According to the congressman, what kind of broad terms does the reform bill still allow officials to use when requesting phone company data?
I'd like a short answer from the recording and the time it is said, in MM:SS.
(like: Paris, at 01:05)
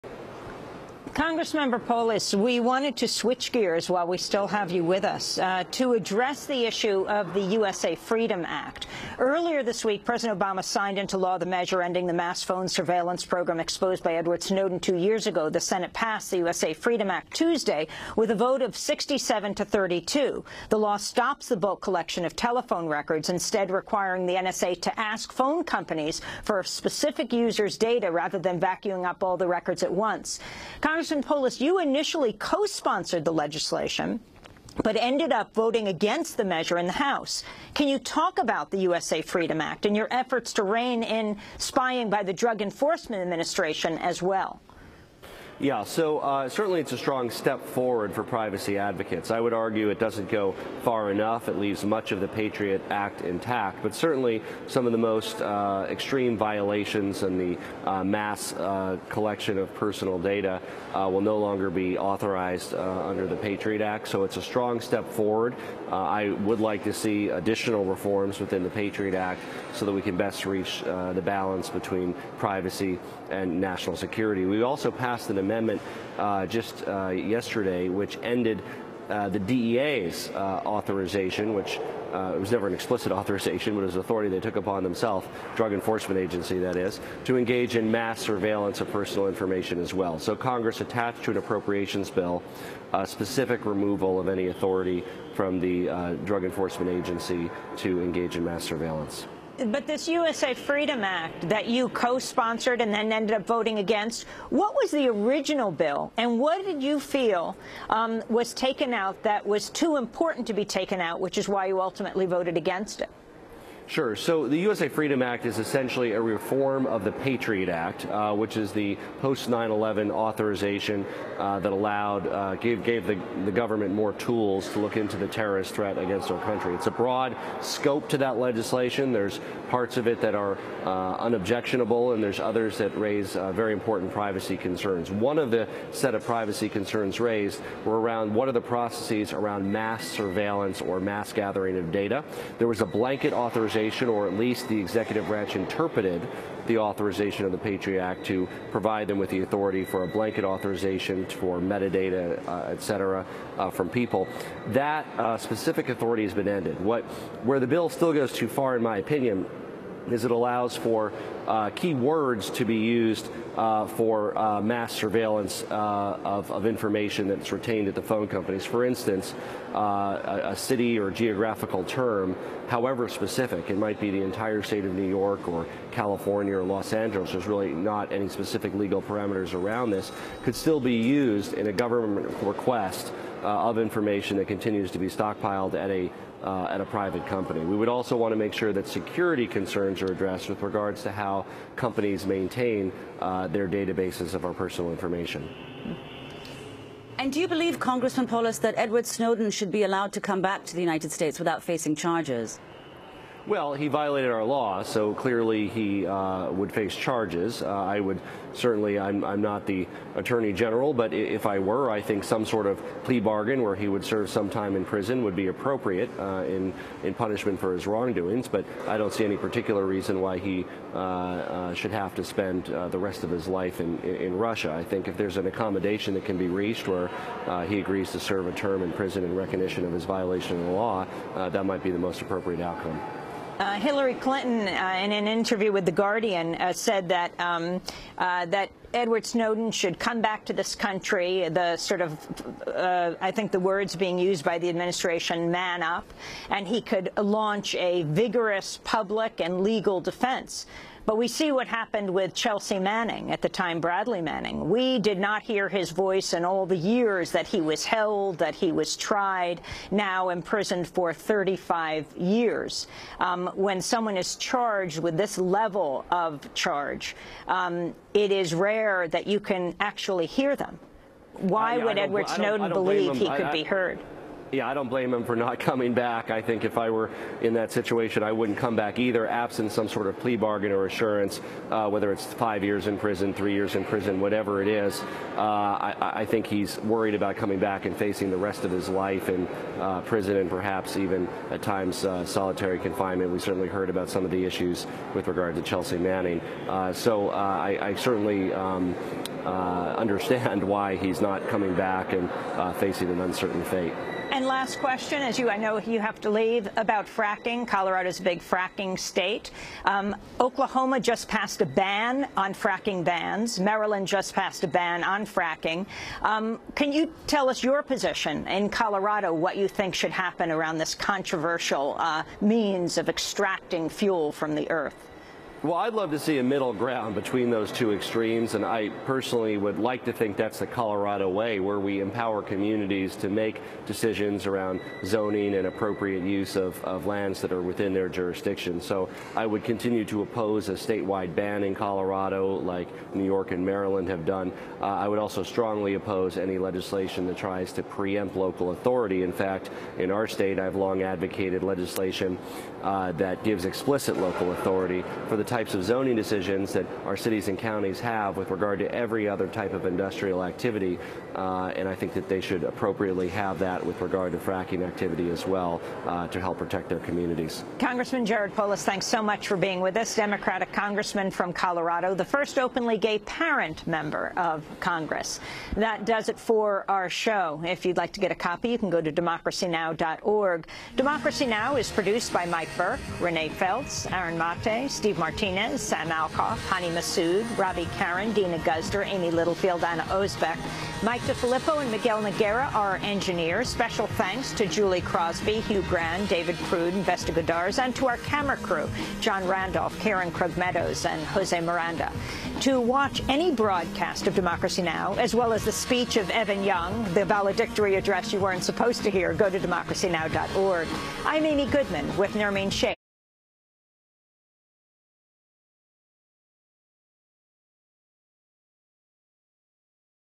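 keywords, at 02:41.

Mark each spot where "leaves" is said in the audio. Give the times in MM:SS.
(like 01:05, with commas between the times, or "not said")
00:51, 05:06.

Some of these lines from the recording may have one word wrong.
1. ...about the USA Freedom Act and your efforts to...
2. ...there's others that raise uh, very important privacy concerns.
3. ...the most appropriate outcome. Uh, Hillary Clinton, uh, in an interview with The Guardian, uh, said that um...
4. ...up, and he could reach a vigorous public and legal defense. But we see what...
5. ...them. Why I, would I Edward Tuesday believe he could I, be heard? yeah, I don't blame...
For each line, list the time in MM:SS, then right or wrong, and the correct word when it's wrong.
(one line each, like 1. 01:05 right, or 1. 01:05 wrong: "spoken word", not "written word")
1. 00:38 right
2. 02:12 right
3. 03:51 right
4. 04:05 wrong: "launch", not "reach"
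5. 04:30 wrong: "Snowden", not "Tuesday".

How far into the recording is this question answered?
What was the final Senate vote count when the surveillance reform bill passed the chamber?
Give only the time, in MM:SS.
00:18.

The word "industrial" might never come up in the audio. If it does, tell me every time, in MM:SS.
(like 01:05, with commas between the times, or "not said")
05:59.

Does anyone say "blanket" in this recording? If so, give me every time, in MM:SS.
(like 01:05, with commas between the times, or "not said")
02:22, 02:30.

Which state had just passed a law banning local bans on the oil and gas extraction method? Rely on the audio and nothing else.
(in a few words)
Oklahoma.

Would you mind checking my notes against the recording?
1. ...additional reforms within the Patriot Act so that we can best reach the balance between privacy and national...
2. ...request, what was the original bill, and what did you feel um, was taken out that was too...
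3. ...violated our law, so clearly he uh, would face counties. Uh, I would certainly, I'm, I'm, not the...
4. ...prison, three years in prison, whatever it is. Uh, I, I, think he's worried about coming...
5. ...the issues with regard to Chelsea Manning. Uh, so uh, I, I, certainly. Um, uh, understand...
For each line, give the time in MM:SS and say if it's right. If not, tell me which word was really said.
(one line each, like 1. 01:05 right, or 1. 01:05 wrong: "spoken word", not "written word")
1. 01:07 right
2. 01:43 wrong: "against", not "request"
3. 03:23 wrong: "charges", not "counties"
4. 04:42 right
5. 04:54 right.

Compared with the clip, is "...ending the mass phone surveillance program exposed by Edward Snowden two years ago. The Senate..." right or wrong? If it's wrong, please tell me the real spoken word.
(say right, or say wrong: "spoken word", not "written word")
right.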